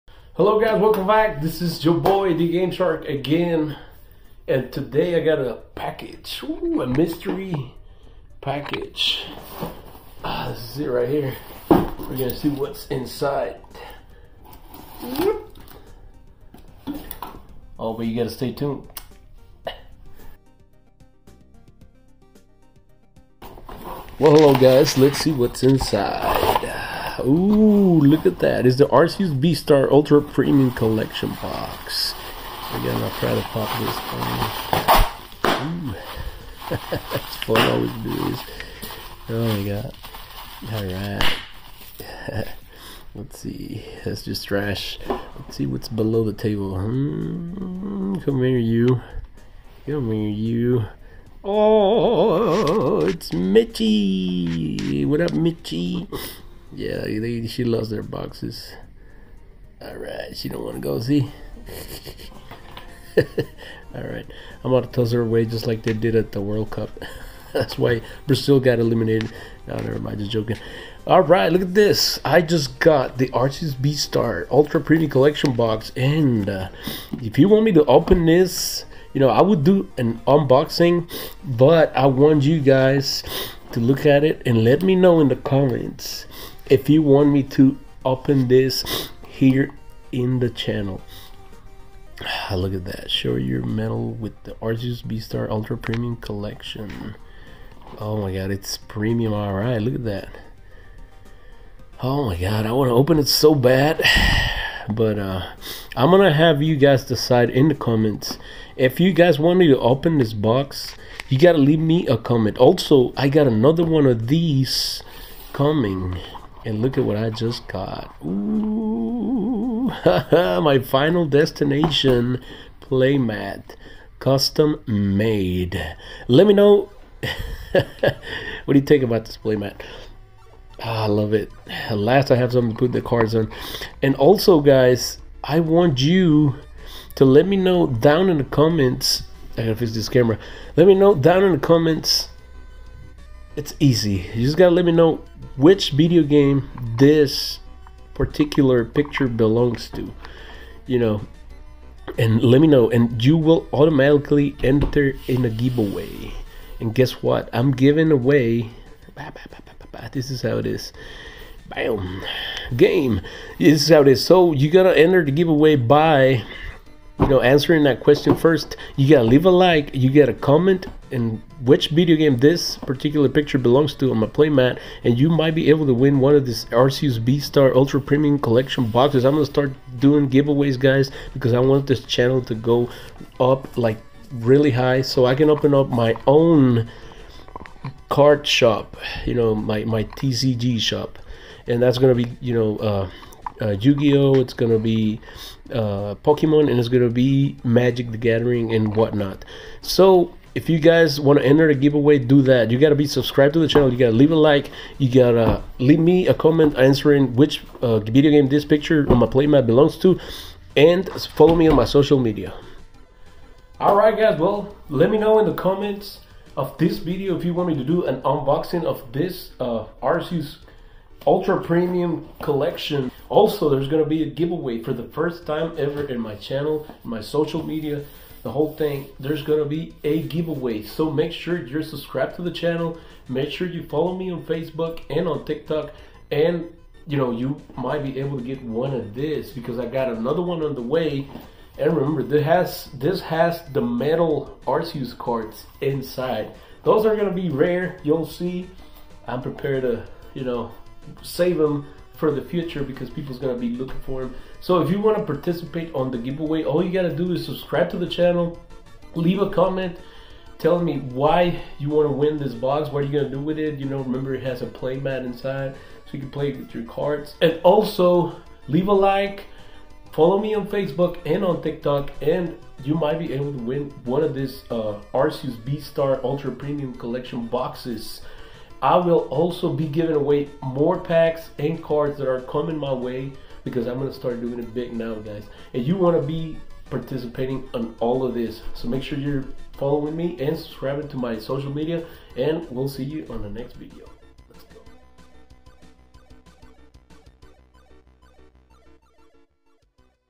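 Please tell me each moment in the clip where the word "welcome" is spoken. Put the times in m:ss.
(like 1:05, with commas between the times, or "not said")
0:00.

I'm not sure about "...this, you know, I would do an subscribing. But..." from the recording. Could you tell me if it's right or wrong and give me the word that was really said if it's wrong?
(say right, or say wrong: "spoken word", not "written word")
wrong: "unboxing", not "subscribing".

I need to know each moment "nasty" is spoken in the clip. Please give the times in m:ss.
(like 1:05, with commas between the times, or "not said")
not said.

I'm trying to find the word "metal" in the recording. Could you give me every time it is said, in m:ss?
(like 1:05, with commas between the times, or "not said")
1:33, 4:03.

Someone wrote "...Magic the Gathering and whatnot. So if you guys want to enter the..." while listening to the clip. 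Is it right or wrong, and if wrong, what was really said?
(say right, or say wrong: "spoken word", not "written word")
right.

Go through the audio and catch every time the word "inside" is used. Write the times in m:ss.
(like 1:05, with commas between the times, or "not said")
0:12, 0:25, 4:05, 4:25.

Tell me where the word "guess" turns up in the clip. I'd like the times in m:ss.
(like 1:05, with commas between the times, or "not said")
2:36.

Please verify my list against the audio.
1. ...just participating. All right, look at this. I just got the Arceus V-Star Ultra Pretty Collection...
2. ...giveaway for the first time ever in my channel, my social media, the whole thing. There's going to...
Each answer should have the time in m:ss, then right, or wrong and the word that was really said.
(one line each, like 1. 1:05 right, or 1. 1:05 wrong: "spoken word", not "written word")
1. 1:10 wrong: "joking", not "participating"
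2. 3:44 right.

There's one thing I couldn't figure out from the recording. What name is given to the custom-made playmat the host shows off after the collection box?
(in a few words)
Final Destination.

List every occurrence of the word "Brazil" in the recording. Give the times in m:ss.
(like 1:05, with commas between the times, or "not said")
1:08.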